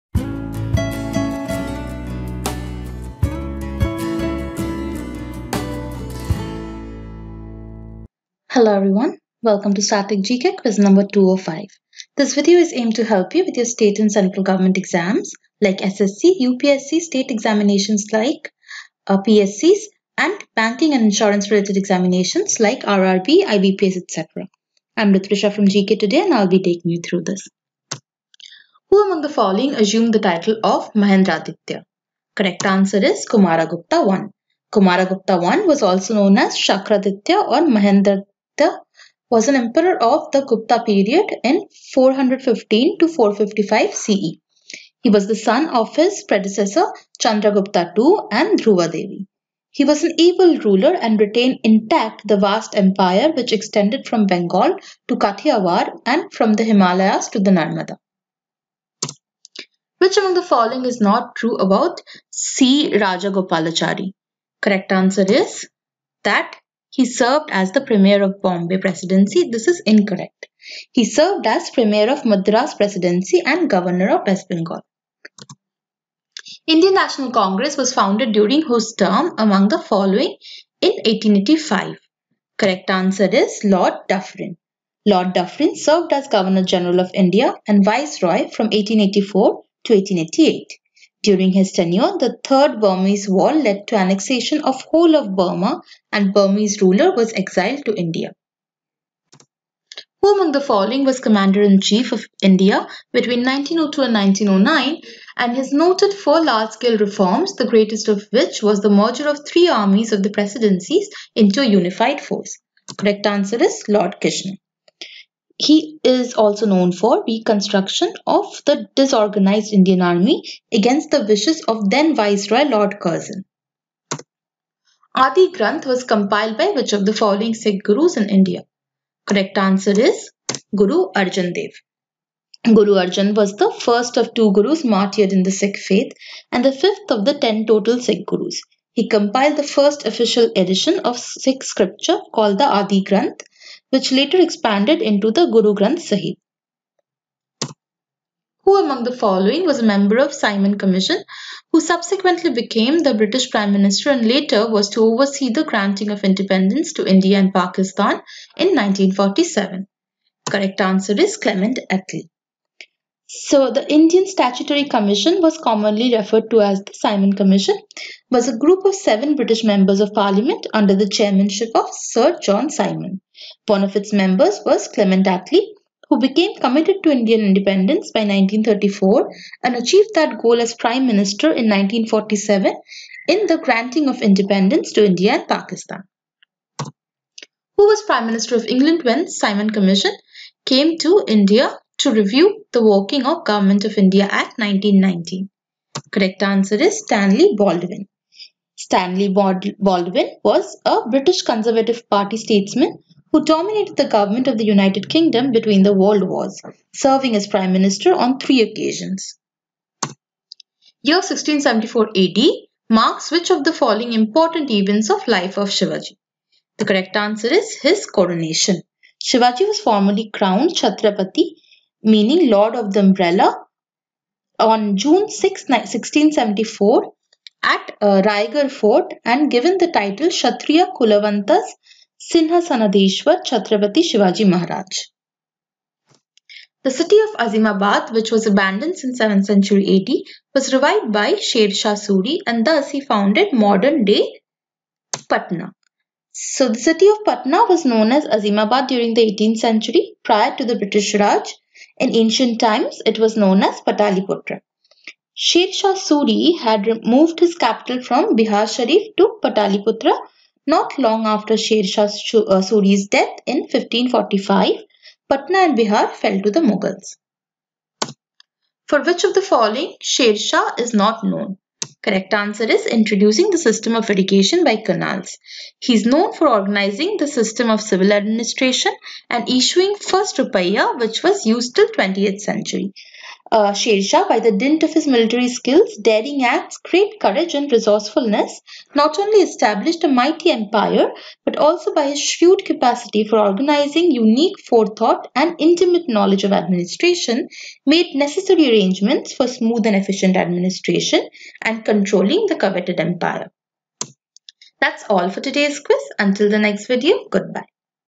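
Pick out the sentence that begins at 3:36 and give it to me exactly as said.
The correct answer is his coronation.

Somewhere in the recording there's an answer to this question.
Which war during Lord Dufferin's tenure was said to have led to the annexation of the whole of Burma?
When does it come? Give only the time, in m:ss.
1:32.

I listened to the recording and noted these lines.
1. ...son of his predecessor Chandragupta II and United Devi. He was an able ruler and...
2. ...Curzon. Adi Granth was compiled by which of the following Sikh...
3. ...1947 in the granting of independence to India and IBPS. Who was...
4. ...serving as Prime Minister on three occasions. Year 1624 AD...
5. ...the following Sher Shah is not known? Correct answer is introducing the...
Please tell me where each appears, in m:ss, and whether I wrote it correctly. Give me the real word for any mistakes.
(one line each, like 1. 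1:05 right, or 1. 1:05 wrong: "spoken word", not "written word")
1. 0:45 wrong: "Dhruva", not "United"
2. 2:02 right
3. 3:01 wrong: "Pakistan", not "IBPS"
4. 3:26 wrong: "1674", not "1624"
5. 4:29 right.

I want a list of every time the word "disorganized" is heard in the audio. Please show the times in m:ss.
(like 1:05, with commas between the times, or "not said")
1:58.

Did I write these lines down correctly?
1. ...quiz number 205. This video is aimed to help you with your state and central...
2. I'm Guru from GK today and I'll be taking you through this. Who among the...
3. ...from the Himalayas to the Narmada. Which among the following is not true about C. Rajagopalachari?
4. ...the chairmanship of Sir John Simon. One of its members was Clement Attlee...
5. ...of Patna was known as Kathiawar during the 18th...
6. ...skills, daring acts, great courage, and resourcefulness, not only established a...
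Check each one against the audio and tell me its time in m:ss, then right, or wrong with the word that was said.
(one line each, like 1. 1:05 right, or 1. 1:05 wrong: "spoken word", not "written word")
1. 0:10 right
2. 0:24 wrong: "Ritrisha", not "Guru"
3. 0:56 right
4. 2:50 right
5. 4:07 wrong: "Azimabad", not "Kathiawar"
6. 4:45 right.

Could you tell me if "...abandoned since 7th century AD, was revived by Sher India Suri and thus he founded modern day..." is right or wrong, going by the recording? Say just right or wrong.
wrong.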